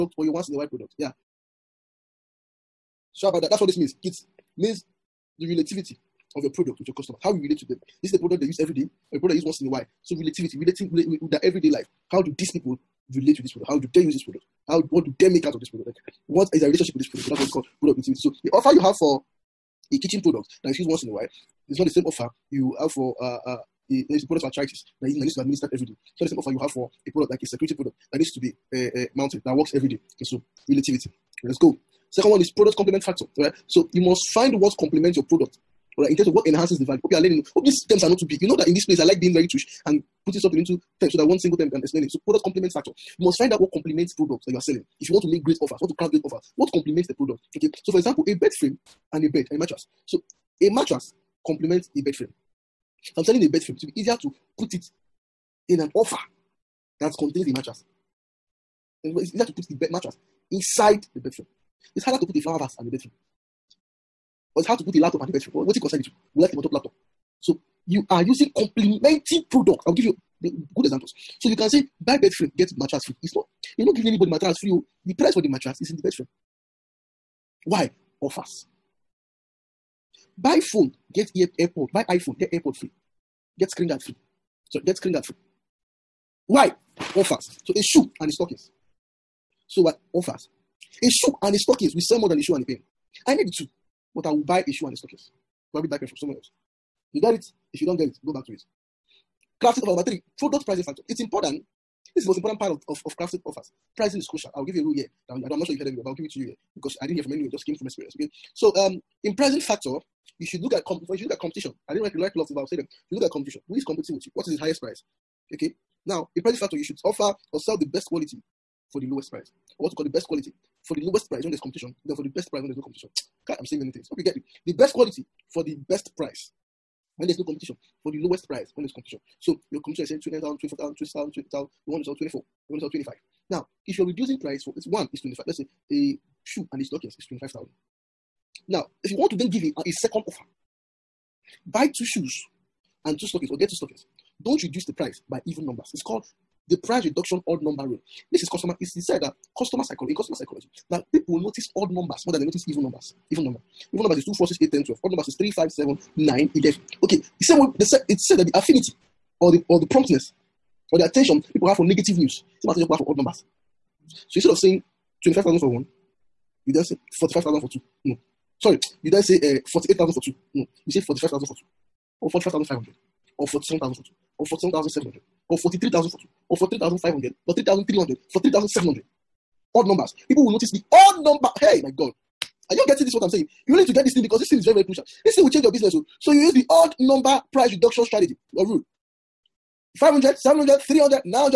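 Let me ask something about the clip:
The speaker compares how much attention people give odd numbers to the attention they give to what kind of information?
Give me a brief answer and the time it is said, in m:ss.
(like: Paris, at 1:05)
negative news, at 2:41.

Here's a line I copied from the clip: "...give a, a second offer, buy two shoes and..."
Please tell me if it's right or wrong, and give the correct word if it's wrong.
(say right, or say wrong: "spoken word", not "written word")
right.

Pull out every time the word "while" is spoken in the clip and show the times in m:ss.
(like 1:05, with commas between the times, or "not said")
0:00, 0:09, 0:21.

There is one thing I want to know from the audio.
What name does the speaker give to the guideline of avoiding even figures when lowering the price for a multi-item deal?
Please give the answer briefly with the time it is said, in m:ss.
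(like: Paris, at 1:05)
price reduction odd number rule, at 2:26.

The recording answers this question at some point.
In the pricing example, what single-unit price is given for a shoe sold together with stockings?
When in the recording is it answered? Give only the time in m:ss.
2:15.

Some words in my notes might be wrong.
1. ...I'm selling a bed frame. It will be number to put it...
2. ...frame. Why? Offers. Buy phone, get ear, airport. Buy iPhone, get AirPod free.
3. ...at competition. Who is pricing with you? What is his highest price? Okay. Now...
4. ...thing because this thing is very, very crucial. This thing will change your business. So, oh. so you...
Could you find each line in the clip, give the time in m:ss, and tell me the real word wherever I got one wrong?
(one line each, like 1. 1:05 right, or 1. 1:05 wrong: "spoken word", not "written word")
1. 0:53 wrong: "easier", not "number"
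2. 1:16 right
3. 1:53 wrong: "competing", not "pricing"
4. 3:04 right.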